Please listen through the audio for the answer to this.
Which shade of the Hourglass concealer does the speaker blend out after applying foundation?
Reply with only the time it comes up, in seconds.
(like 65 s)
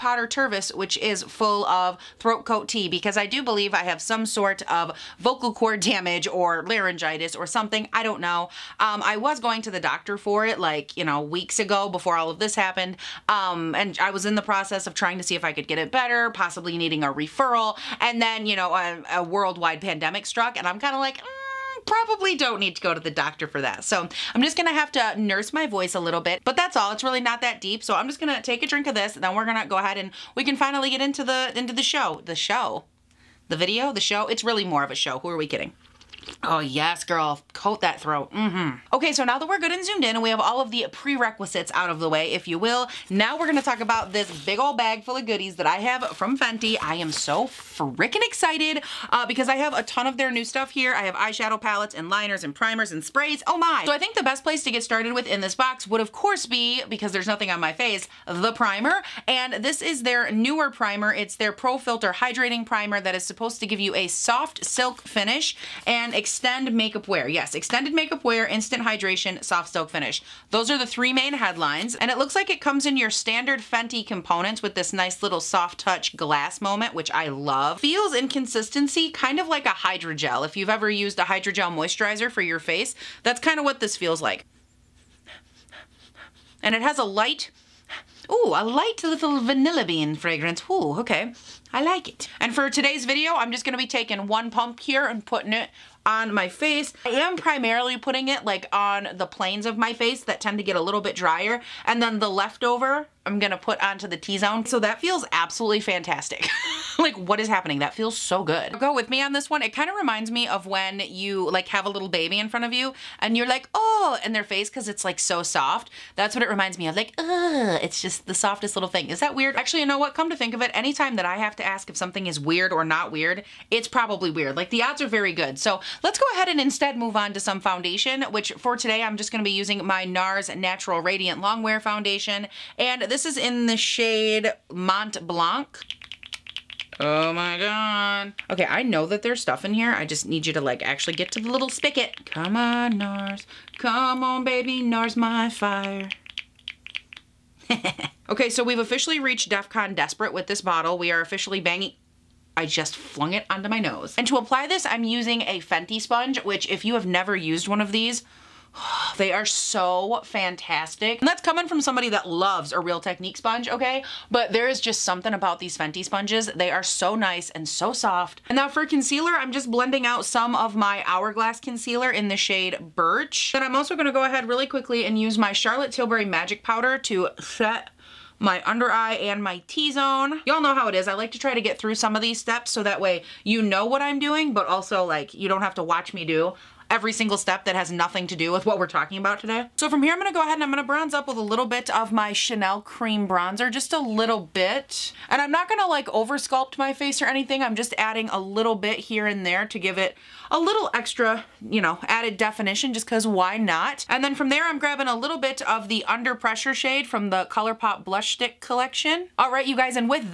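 172 s.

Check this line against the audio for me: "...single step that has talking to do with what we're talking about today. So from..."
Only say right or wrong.
wrong.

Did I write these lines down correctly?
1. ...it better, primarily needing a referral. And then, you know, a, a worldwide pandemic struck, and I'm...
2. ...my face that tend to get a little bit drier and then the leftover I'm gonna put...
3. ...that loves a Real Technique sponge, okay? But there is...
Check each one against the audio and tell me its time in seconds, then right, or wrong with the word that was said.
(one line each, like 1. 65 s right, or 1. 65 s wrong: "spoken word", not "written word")
1. 15 s wrong: "possibly", not "primarily"
2. 99 s right
3. 162 s right.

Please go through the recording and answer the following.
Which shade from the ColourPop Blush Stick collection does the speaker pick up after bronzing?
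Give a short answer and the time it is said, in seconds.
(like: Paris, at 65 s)
Under Pressure, at 206 s.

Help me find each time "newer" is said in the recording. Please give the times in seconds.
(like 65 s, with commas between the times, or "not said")
60 s.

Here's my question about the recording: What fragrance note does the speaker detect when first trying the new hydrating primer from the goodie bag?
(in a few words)
Vanilla bean.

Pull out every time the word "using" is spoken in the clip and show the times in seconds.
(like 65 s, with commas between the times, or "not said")
129 s, 155 s.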